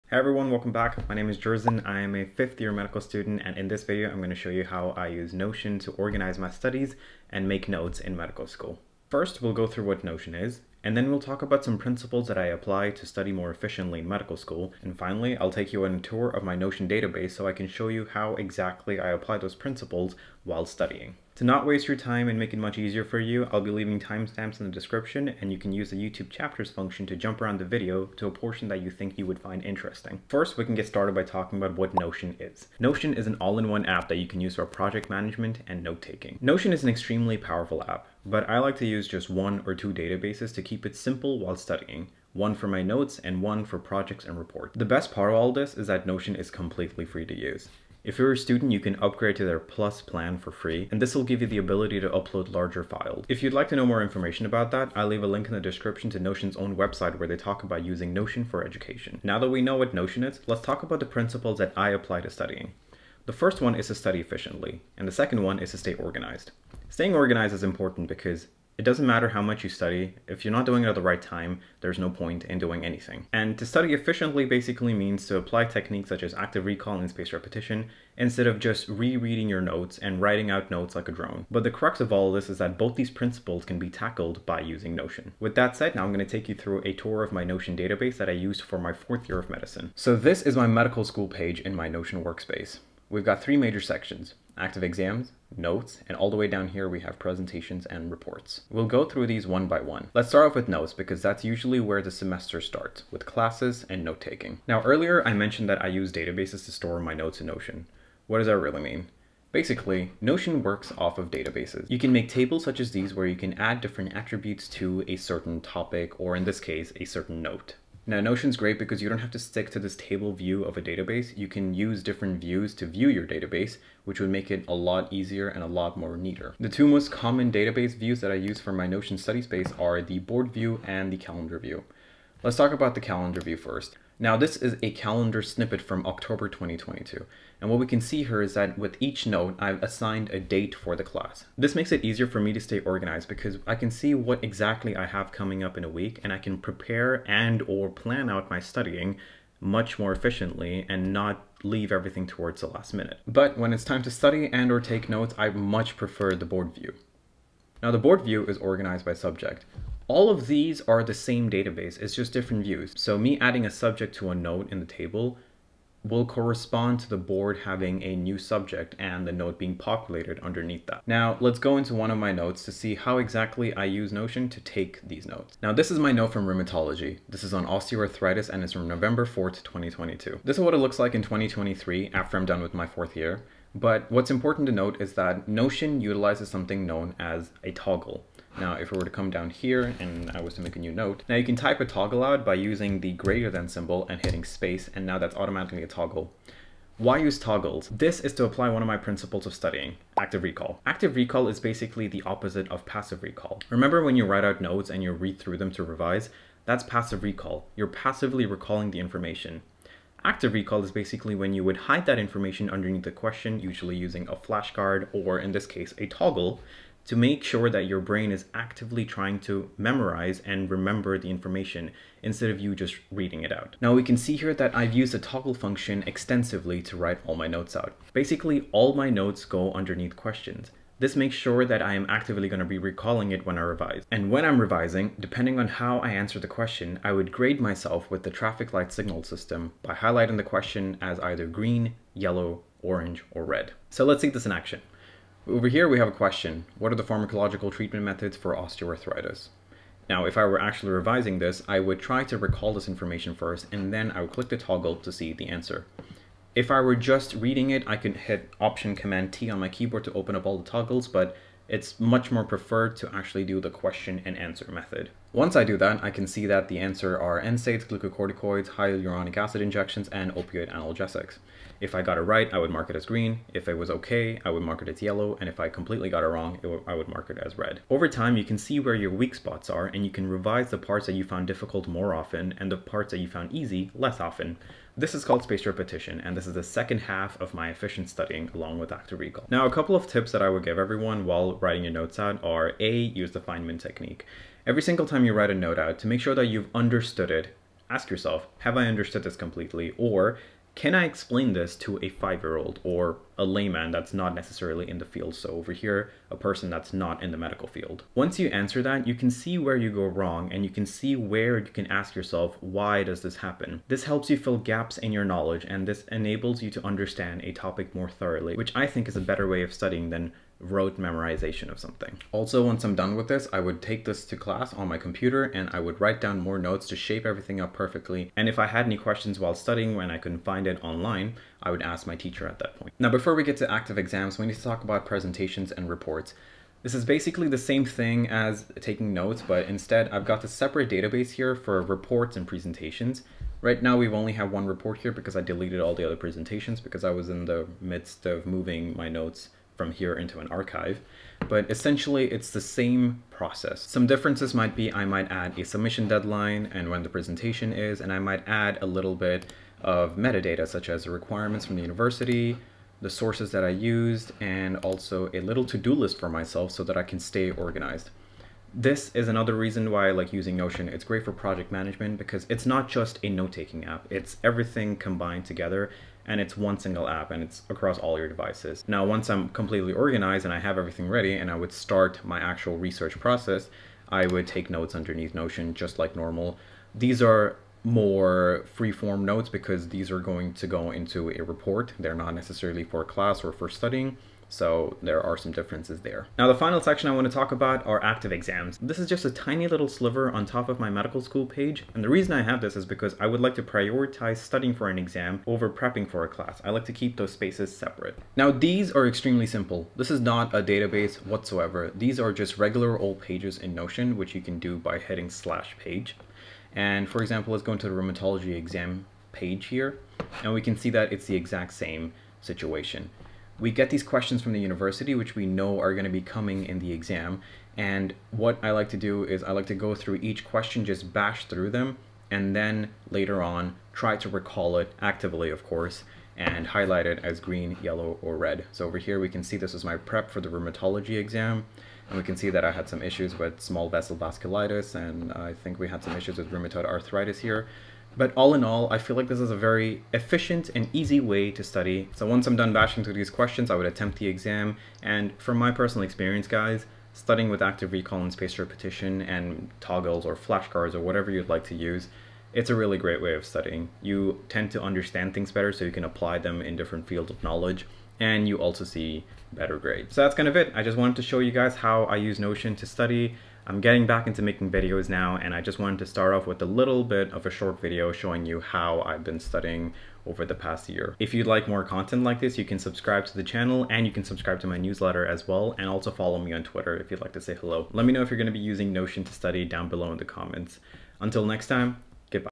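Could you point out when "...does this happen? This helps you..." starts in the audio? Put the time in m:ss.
5:13.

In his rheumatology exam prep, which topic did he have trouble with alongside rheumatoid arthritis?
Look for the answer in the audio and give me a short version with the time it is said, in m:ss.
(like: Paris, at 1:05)
Small vessel vasculitis, at 7:23.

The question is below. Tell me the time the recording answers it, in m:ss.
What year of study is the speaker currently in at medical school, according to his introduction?
0:02.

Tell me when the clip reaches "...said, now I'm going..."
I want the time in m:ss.
1:25.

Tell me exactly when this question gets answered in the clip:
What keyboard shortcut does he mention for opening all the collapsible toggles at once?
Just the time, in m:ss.
4:18.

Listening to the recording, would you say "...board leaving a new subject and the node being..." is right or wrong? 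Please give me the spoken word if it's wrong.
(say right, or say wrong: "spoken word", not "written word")
wrong: "having", not "leaving".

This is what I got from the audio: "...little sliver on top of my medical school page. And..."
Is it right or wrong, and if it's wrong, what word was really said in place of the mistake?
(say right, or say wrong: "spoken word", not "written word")
right.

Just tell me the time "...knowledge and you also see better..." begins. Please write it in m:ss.
7:47.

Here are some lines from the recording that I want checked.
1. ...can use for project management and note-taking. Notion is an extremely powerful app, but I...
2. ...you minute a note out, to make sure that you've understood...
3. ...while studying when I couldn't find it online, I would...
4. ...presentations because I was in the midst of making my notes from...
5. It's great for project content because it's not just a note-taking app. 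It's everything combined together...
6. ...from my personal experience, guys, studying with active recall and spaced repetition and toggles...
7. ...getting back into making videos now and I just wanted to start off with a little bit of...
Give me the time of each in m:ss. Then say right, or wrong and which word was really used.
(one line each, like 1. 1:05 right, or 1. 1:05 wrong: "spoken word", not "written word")
1. 0:34 right
2. 4:55 wrong: "write", not "minute"
3. 5:29 right
4. 5:46 wrong: "moving", not "making"
5. 6:10 wrong: "management", not "content"
6. 7:35 right
7. 7:53 right.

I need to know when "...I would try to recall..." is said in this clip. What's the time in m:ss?
4:11.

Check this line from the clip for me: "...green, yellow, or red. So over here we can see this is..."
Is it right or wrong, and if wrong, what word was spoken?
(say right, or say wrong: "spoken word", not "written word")
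right.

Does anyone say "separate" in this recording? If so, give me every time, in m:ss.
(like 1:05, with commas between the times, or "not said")
5:40, 6:47.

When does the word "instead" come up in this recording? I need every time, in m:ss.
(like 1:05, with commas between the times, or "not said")
1:18, 3:42, 5:39.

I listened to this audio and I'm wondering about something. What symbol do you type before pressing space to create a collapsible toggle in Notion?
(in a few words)
Greater than symbol.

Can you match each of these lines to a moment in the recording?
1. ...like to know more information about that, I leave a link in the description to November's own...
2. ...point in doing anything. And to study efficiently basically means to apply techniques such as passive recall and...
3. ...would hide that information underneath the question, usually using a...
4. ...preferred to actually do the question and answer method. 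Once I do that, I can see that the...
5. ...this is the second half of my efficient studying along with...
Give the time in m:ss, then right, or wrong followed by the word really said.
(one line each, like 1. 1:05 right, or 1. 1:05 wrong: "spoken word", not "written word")
1. 0:53 wrong: "Notion", not "November"
2. 1:12 wrong: "active", not "passive"
3. 3:31 right
4. 4:22 right
5. 4:46 right.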